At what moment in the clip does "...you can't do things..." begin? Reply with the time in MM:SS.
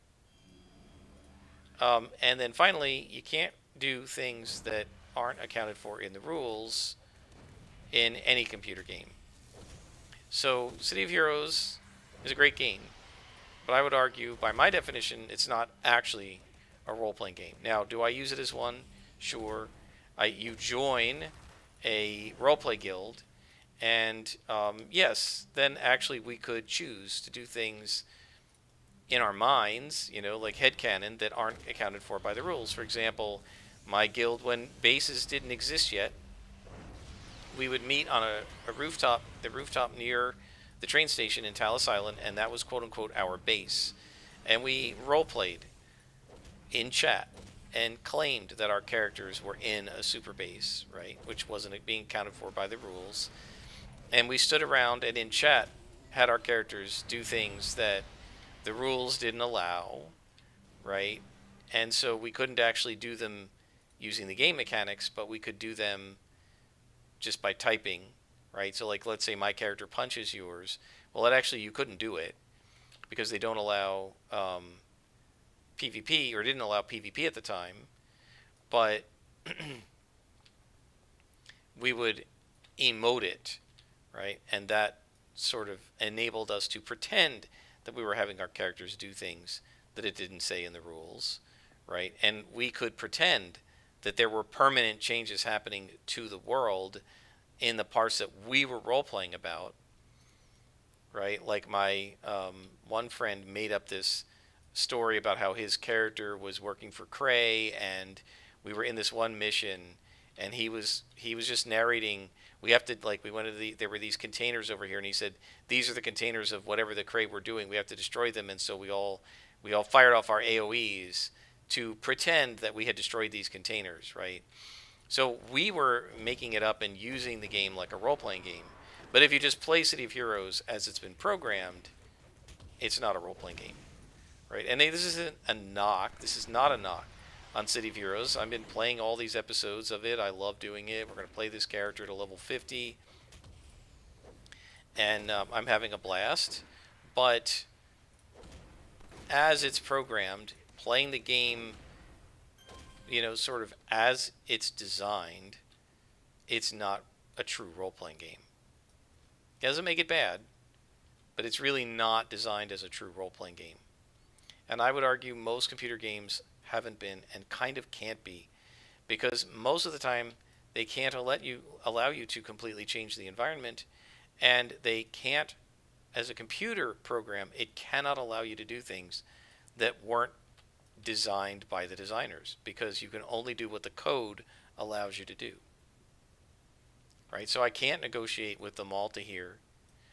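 00:03.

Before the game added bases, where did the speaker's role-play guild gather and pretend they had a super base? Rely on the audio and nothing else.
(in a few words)
Talos Island.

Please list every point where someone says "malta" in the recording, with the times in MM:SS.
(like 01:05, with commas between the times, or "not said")
03:08.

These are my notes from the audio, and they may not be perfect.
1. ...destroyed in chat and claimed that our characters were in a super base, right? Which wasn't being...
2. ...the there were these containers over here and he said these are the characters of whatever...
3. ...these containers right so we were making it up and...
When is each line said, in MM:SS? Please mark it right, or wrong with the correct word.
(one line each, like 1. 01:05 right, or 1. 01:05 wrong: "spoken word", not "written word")
1. 00:45 wrong: "played", not "destroyed"
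2. 01:53 wrong: "containers", not "characters"
3. 02:03 right.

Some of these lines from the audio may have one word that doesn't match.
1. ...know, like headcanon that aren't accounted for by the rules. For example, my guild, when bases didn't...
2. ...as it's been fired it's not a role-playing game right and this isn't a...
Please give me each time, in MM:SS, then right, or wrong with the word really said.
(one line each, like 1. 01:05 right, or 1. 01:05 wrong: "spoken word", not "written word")
1. 00:30 right
2. 02:10 wrong: "programmed", not "fired".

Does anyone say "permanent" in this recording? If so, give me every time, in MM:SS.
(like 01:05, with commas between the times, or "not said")
01:34.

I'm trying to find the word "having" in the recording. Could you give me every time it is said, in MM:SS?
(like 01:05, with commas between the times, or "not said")
01:28, 02:25.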